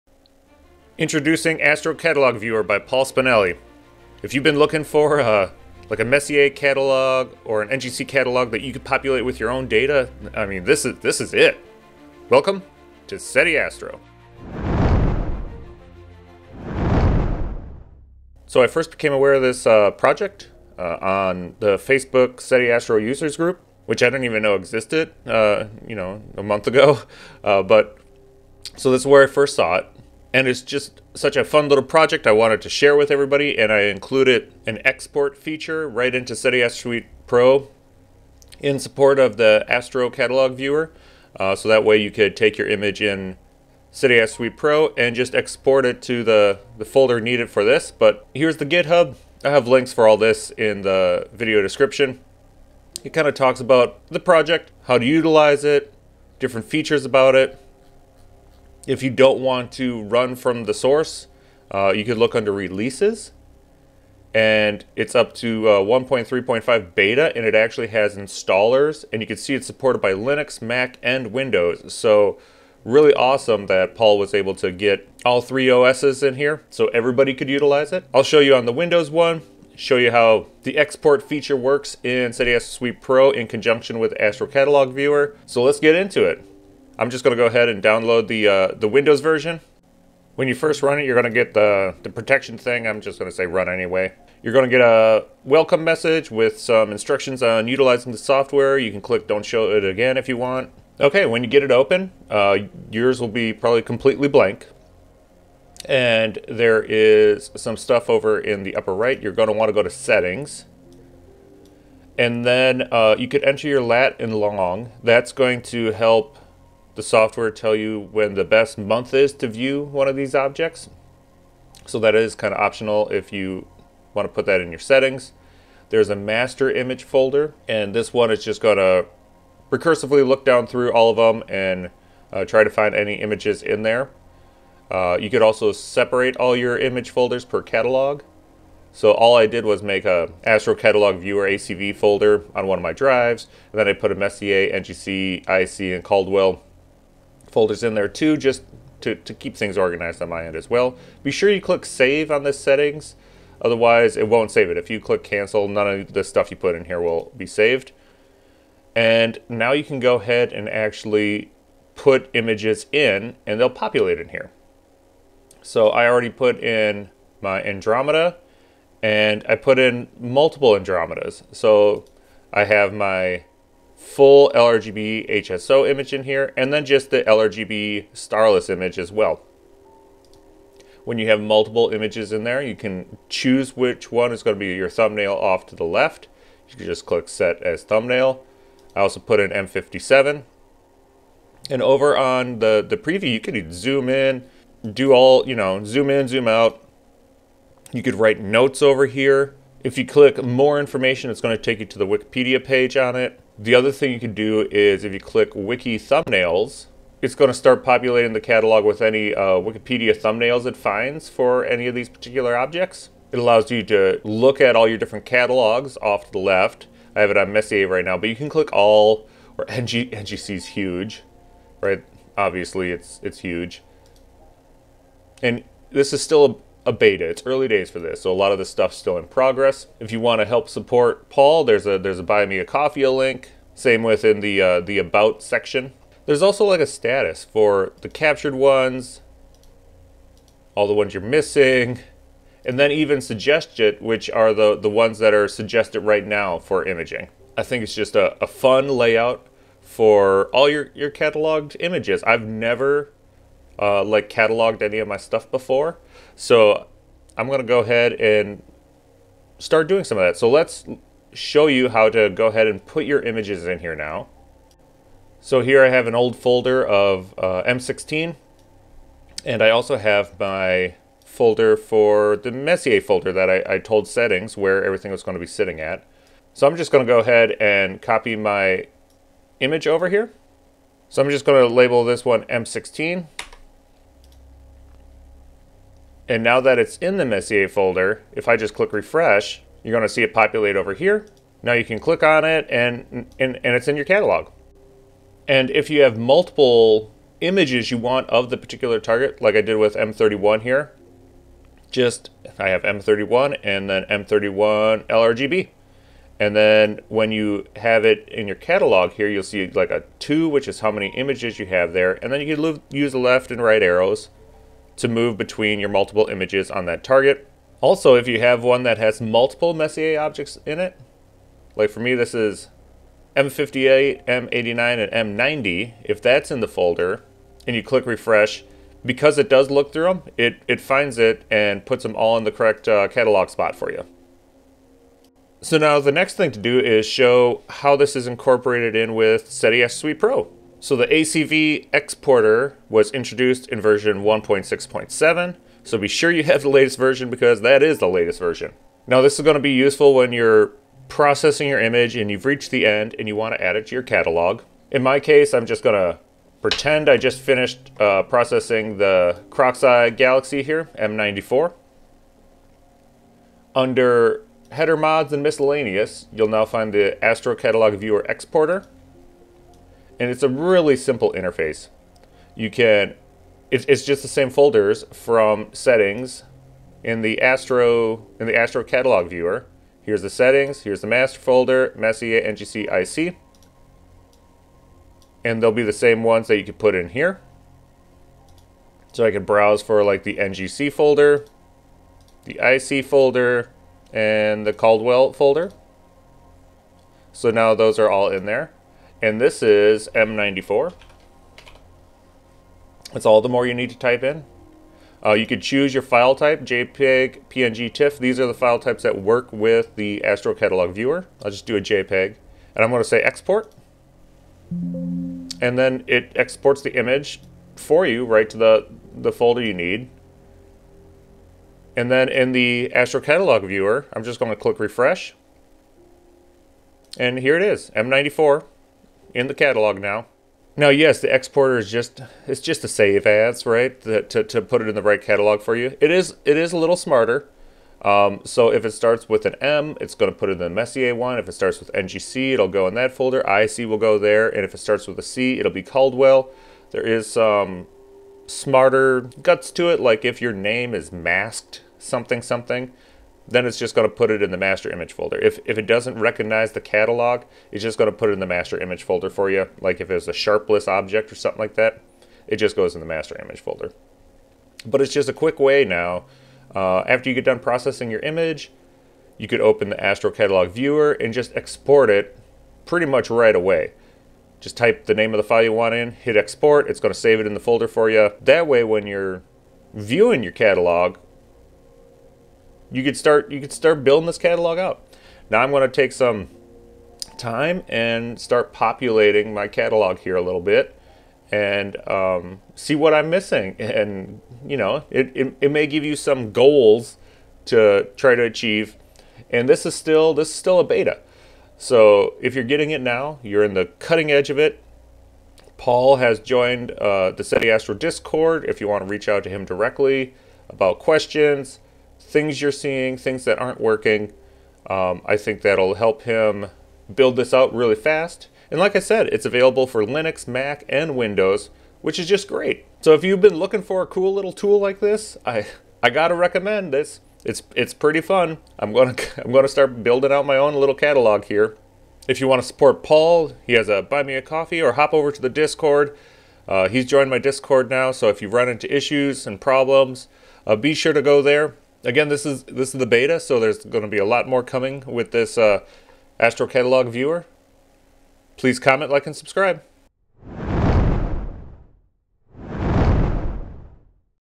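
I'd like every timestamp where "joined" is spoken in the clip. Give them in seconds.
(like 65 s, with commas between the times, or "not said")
506 s, 537 s.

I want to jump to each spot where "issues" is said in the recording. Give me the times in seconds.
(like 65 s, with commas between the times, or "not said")
538 s.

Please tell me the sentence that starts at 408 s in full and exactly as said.
These are the file types that work with the Astro Catalog Viewer.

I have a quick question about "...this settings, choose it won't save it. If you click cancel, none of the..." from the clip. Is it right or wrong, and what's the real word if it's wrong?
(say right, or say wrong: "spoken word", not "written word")
wrong: "otherwise", not "choose".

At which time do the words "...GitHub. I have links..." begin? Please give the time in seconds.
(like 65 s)
48 s.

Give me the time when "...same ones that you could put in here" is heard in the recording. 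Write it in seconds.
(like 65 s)
385 s.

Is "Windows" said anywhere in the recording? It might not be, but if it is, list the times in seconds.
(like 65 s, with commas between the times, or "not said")
71 s, 78 s, 88 s, 521 s.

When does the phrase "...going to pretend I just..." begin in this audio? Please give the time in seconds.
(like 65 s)
355 s.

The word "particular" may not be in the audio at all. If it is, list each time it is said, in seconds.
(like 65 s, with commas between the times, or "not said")
212 s, 298 s.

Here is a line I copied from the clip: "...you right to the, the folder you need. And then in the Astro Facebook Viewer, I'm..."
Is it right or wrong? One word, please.
wrong.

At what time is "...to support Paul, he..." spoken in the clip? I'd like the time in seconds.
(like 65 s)
532 s.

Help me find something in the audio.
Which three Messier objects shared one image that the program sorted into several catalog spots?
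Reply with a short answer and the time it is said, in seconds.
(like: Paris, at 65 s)
M58, M89, M90, at 323 s.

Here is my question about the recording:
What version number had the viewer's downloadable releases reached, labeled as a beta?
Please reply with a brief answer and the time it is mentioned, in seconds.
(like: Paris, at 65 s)
1.3.5, at 65 s.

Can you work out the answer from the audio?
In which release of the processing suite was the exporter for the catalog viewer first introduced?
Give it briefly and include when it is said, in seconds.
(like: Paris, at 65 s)
1.6.7, at 344 s.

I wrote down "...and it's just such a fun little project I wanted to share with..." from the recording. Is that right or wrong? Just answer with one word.
right.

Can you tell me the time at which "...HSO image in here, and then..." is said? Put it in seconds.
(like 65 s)
175 s.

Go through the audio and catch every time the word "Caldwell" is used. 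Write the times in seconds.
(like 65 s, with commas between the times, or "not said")
146 s, 394 s, 445 s.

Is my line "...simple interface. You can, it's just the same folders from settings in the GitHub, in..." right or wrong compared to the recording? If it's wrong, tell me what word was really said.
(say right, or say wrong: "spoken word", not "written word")
wrong: "Astro", not "GitHub".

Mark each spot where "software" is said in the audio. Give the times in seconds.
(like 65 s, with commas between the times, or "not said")
98 s, 117 s.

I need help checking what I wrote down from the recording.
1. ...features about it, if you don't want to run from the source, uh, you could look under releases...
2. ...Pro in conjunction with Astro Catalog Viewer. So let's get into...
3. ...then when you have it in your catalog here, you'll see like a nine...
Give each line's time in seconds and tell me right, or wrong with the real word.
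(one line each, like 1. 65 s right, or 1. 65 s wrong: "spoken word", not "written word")
1. 56 s right
2. 82 s right
3. 306 s wrong: "two", not "nine".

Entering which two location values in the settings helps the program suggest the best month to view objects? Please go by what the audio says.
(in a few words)
lat and long.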